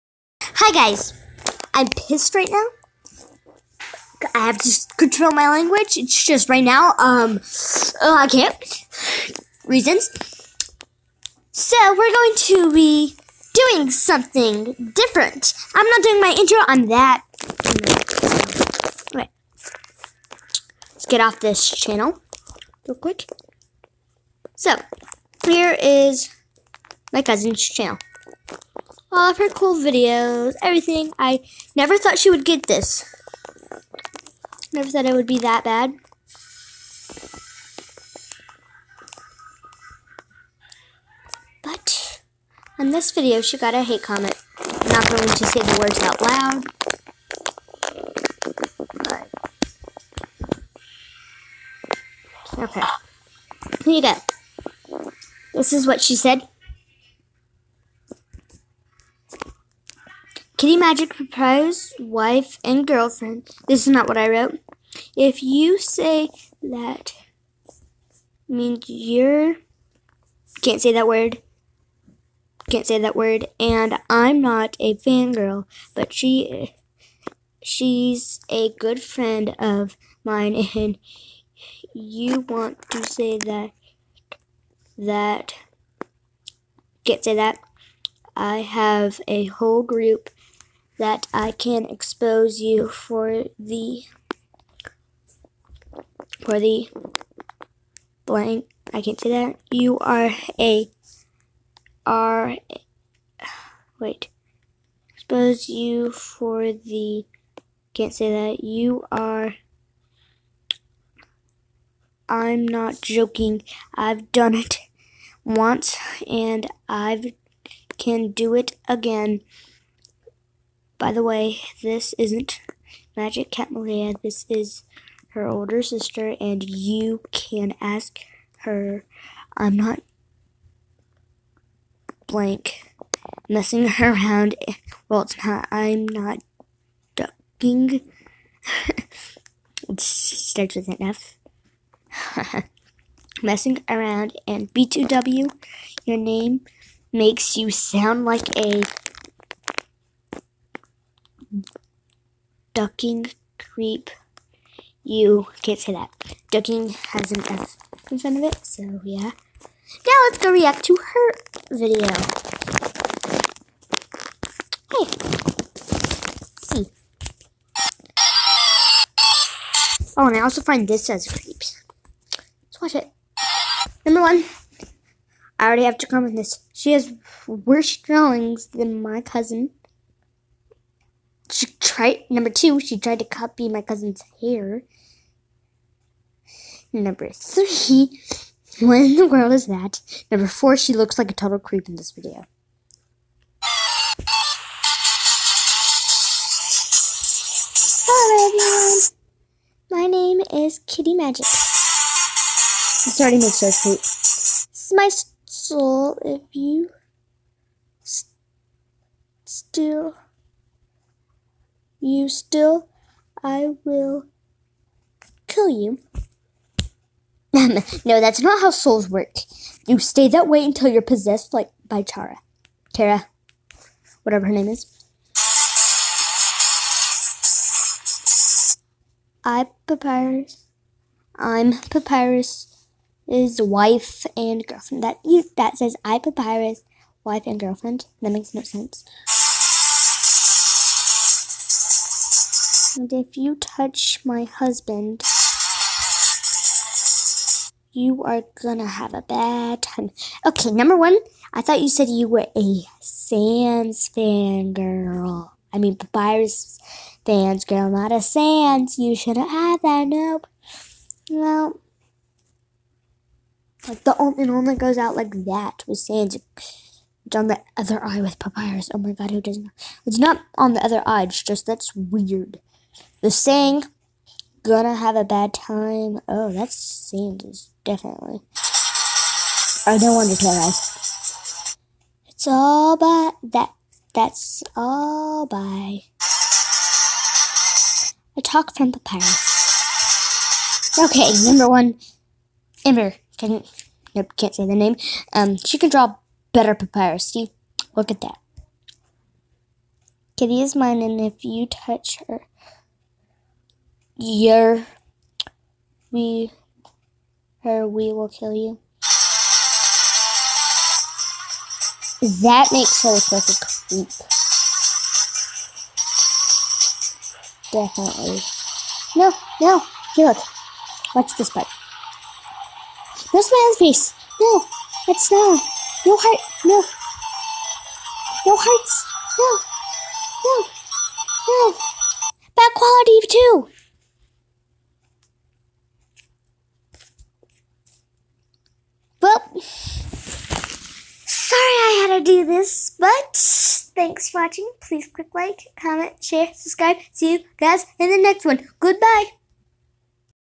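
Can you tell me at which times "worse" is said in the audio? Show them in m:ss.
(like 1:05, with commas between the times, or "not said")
2:57.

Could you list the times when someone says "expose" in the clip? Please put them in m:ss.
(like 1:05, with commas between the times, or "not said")
1:31, 1:45.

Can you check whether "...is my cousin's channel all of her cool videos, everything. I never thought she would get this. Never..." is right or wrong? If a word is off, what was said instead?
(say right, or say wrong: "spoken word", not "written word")
right.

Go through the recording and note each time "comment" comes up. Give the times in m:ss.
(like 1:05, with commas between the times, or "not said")
0:44, 2:56, 5:45.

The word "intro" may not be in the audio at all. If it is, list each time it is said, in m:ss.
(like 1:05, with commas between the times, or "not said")
0:16.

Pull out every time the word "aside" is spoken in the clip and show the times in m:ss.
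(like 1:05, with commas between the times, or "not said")
not said.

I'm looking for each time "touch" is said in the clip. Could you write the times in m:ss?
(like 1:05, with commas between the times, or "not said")
4:03, 5:01.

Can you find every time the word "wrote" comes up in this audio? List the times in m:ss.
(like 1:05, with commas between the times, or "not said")
1:04.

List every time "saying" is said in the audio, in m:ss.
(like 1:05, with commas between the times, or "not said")
4:33.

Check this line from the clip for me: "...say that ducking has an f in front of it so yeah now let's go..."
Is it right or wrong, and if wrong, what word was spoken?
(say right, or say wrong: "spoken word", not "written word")
right.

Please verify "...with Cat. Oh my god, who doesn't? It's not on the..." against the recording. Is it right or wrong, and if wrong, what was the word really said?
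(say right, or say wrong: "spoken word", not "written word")
wrong: "Papyrus", not "Cat".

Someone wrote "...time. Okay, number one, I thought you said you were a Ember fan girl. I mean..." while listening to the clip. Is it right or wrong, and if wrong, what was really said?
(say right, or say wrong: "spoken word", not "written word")
wrong: "Sans", not "Ember".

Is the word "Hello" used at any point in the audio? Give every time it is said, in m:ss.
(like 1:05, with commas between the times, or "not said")
3:18.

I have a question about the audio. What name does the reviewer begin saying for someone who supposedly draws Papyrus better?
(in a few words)
Ember.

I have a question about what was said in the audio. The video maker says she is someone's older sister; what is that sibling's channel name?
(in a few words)
Magic Cat Malia.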